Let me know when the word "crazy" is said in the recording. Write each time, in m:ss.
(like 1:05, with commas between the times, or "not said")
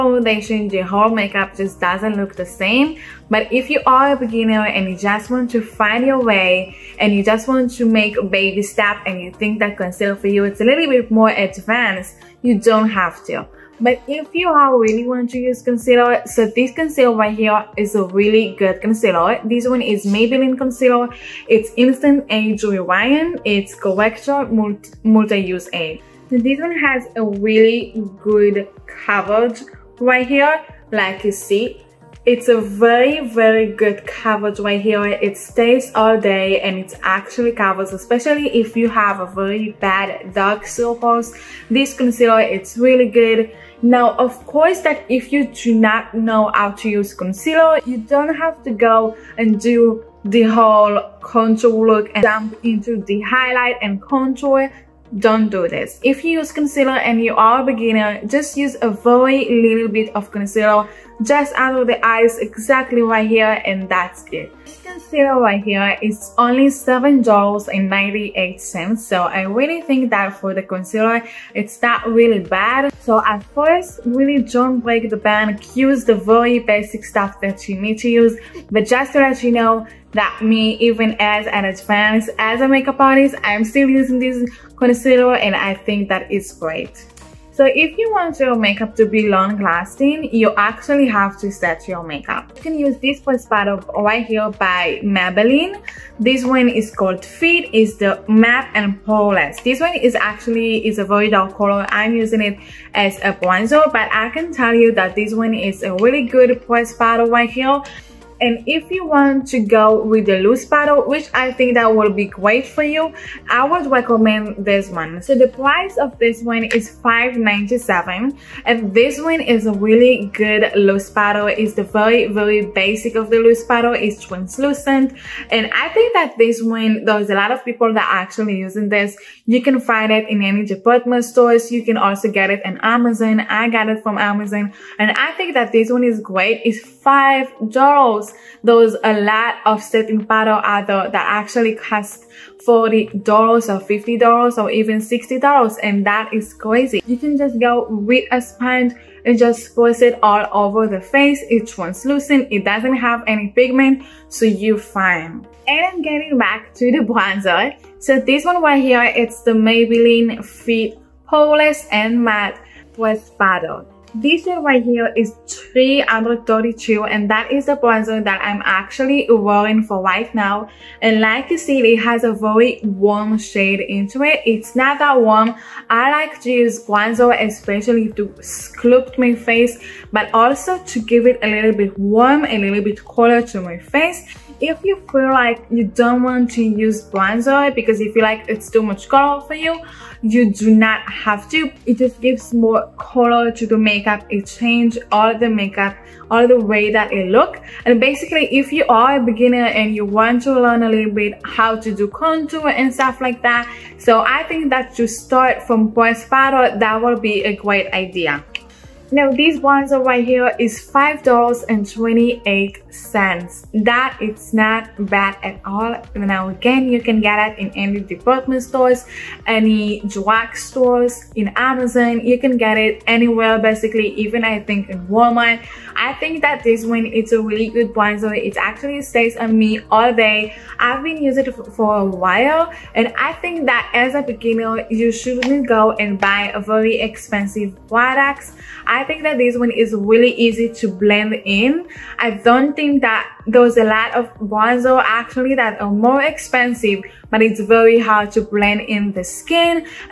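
2:26.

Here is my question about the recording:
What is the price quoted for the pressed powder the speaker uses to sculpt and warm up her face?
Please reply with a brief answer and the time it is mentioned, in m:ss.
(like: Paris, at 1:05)
$5.28, at 3:30.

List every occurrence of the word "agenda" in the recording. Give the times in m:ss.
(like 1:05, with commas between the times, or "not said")
not said.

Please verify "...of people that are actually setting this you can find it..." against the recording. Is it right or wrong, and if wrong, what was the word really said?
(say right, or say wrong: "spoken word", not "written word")
wrong: "using", not "setting".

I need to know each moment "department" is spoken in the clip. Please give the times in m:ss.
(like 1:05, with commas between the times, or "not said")
2:10, 3:37.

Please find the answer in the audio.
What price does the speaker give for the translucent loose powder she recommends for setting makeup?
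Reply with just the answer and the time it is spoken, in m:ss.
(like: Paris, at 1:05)
$5.97, at 1:57.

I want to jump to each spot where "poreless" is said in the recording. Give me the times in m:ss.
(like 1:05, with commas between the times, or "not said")
1:39, 2:41.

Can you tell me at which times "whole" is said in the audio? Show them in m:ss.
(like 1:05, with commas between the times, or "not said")
0:00, 0:50.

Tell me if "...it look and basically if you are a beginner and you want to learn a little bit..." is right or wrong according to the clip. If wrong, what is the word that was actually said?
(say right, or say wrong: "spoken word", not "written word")
right.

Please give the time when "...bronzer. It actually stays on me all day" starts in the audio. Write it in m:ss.
3:47.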